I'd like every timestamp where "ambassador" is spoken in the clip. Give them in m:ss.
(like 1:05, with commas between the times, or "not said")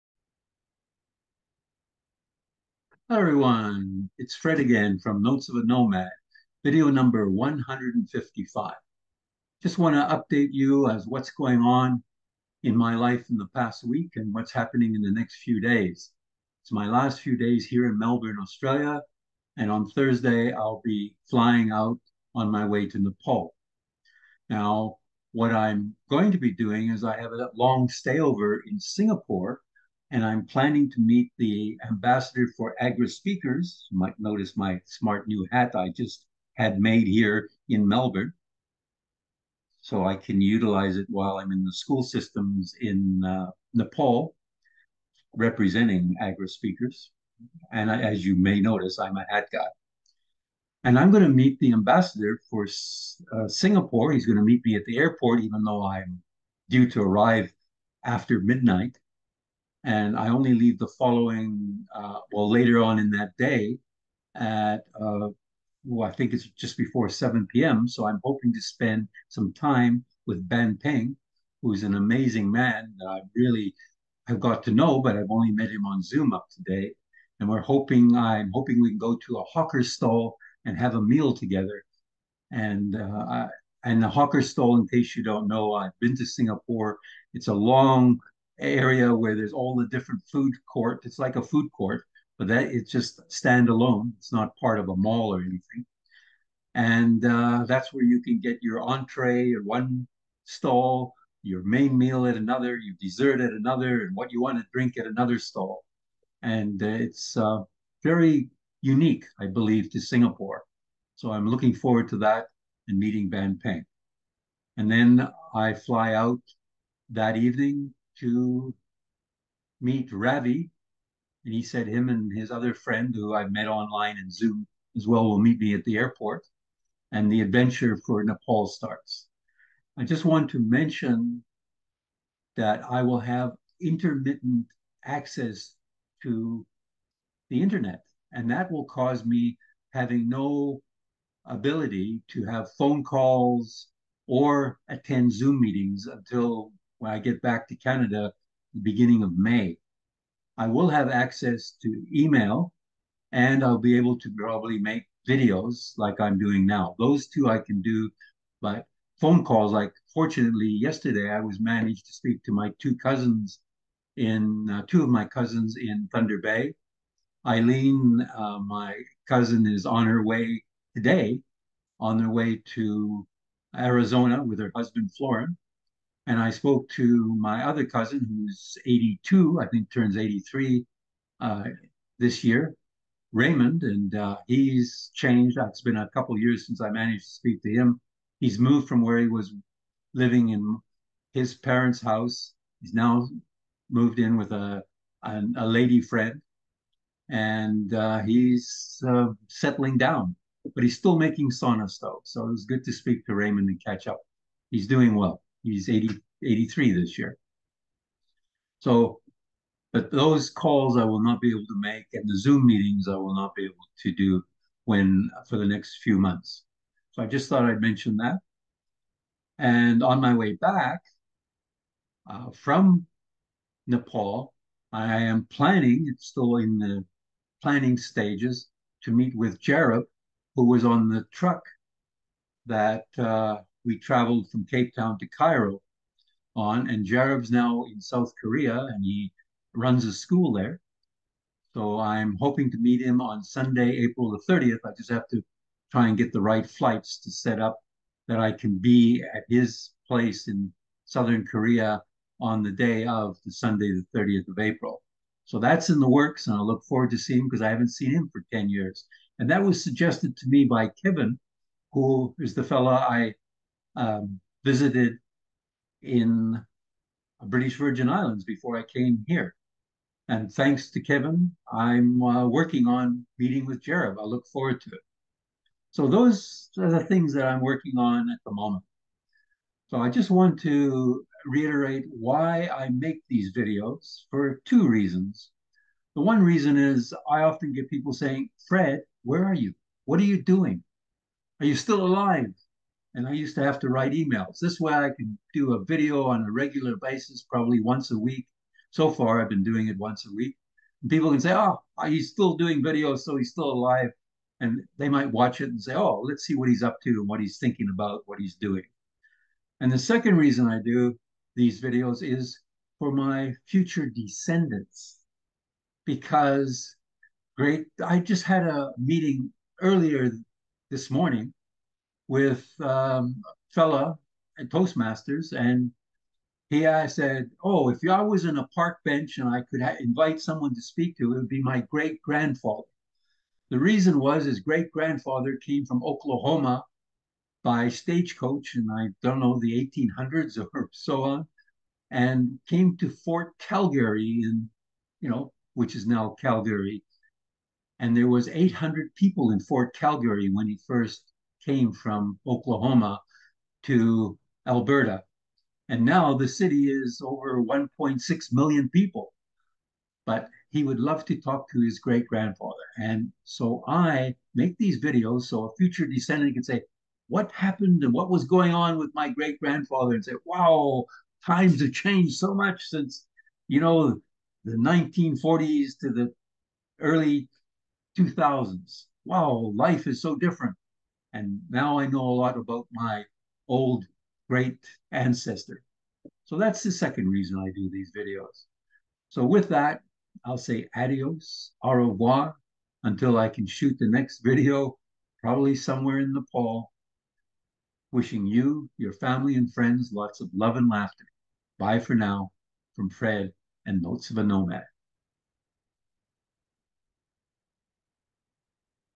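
0:31, 0:51.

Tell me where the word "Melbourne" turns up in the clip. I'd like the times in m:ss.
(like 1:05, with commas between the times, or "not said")
0:17, 0:37.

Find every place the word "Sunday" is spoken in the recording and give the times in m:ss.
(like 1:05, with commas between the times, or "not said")
4:03, 4:13.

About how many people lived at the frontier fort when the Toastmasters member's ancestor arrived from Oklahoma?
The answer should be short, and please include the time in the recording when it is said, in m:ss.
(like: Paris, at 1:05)
800, at 5:48.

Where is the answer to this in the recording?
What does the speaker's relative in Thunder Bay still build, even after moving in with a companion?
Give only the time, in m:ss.
3:21.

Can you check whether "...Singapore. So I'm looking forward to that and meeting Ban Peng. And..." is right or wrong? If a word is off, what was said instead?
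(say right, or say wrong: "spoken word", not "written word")
right.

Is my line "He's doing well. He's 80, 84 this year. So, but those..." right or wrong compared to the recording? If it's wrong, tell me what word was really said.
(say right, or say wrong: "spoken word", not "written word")
wrong: "83", not "84".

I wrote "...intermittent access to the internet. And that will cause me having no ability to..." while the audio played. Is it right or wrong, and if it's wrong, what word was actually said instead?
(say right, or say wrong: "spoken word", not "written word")
right.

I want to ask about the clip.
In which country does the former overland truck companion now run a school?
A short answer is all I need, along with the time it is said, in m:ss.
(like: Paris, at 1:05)
South Korea, at 3:57.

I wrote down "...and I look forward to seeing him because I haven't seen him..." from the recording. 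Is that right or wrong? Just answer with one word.
right.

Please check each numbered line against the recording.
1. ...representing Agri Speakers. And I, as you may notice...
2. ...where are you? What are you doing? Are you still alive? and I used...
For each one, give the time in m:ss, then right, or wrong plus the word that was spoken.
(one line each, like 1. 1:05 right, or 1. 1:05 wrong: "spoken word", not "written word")
1. 0:45 right
2. 4:49 right.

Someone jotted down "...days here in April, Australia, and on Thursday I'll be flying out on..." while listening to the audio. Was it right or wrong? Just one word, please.
wrong.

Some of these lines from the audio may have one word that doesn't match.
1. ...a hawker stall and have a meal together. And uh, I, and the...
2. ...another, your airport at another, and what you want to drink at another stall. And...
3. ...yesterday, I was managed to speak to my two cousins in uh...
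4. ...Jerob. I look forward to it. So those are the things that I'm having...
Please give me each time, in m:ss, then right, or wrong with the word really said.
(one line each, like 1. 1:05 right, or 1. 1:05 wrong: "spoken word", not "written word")
1. 1:19 right
2. 1:42 wrong: "dessert", not "airport"
3. 2:40 right
4. 4:33 wrong: "working", not "having".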